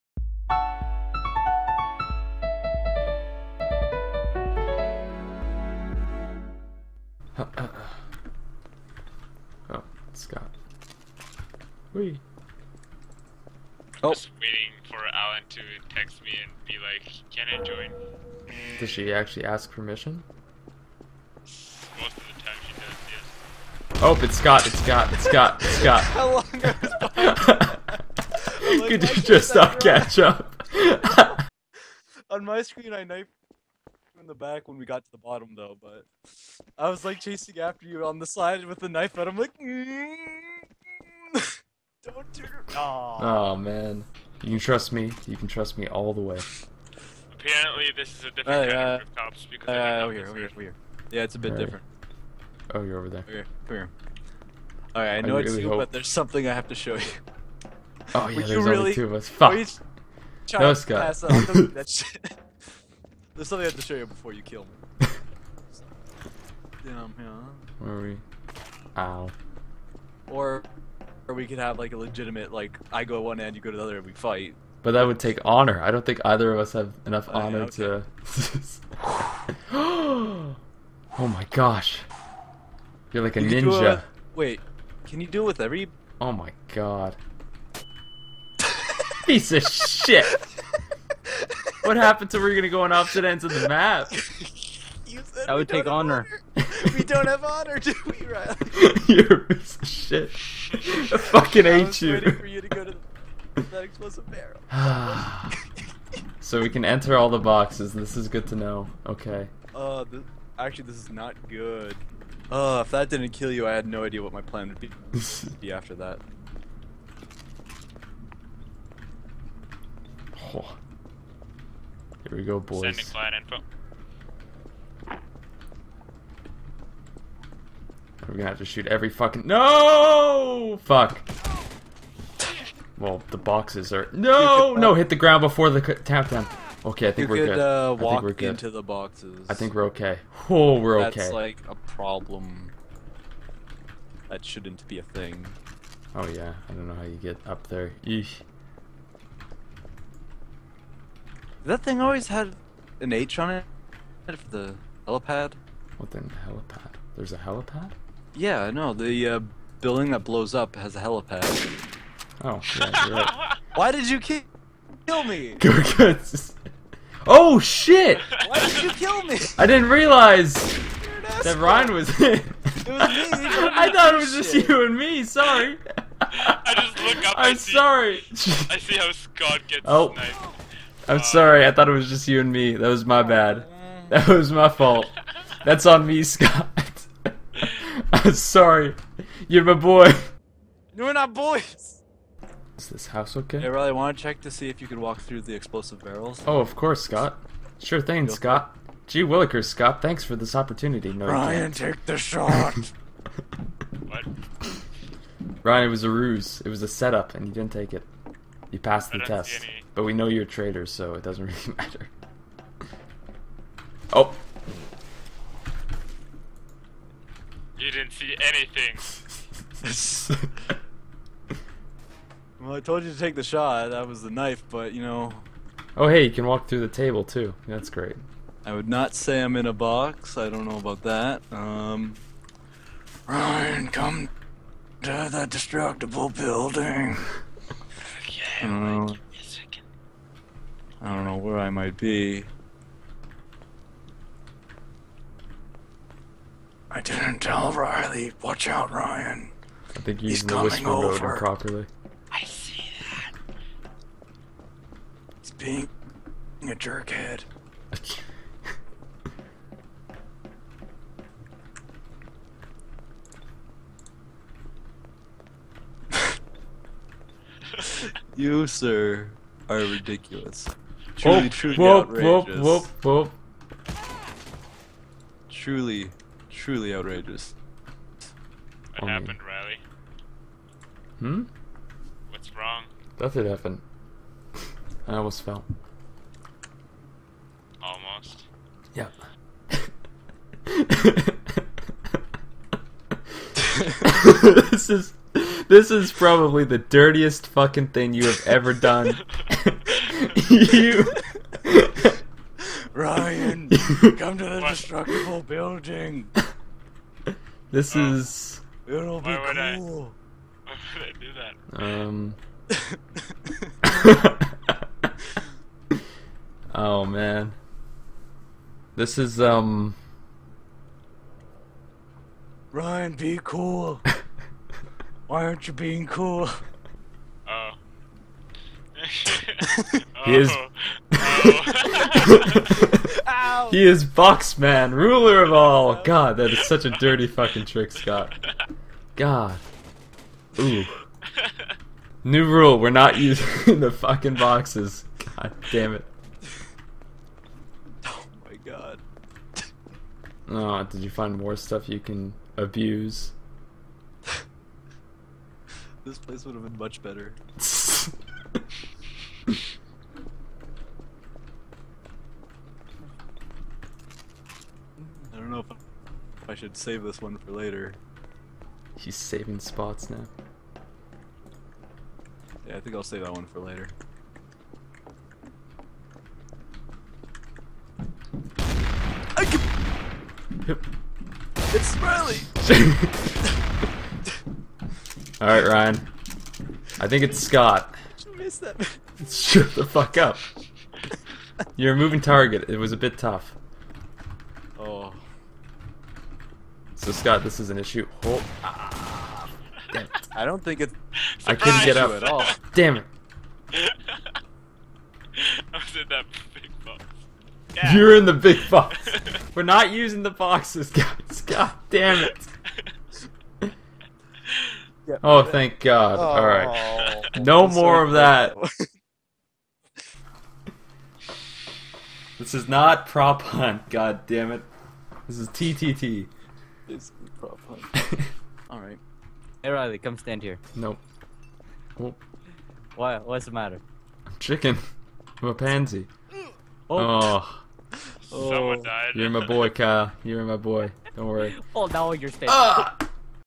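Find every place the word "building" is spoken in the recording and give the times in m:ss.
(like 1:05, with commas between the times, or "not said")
2:39, 3:56, 5:05.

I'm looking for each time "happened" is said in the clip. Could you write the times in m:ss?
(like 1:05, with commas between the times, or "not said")
1:31, 4:39, 4:43.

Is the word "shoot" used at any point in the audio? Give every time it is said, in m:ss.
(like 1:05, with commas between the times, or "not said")
2:08.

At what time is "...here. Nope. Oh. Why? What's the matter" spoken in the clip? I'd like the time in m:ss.
7:10.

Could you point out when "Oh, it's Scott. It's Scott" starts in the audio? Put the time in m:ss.
0:24.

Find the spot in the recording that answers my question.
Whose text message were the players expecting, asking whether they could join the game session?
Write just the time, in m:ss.
0:15.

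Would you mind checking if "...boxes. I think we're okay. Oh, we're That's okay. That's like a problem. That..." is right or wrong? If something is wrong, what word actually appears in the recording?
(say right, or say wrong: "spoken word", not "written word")
right.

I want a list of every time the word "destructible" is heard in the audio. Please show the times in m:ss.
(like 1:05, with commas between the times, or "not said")
3:55, 5:04.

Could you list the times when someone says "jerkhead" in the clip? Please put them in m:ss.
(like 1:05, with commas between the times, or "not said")
4:16.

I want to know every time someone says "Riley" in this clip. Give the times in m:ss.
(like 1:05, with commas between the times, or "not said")
1:38, 3:13, 4:07, 4:39, 7:09.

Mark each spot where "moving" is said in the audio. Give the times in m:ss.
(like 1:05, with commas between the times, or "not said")
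6:31.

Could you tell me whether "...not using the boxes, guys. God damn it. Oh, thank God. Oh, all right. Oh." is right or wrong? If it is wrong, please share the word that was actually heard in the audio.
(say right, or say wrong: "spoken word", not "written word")
right.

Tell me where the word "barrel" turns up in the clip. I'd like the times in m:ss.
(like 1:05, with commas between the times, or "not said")
1:44, 3:16.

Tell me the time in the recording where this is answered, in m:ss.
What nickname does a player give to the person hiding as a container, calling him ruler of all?
5:34.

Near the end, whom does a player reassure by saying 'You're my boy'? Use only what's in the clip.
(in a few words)
Kyle.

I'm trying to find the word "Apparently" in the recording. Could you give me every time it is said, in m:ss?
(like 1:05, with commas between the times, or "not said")
0:47.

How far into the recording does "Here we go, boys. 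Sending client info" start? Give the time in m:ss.
2:02.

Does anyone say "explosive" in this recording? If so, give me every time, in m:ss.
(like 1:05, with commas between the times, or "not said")
1:43, 3:15.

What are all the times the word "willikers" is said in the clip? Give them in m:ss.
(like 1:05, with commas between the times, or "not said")
3:19.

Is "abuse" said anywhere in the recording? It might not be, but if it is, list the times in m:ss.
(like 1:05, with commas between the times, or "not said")
5:52.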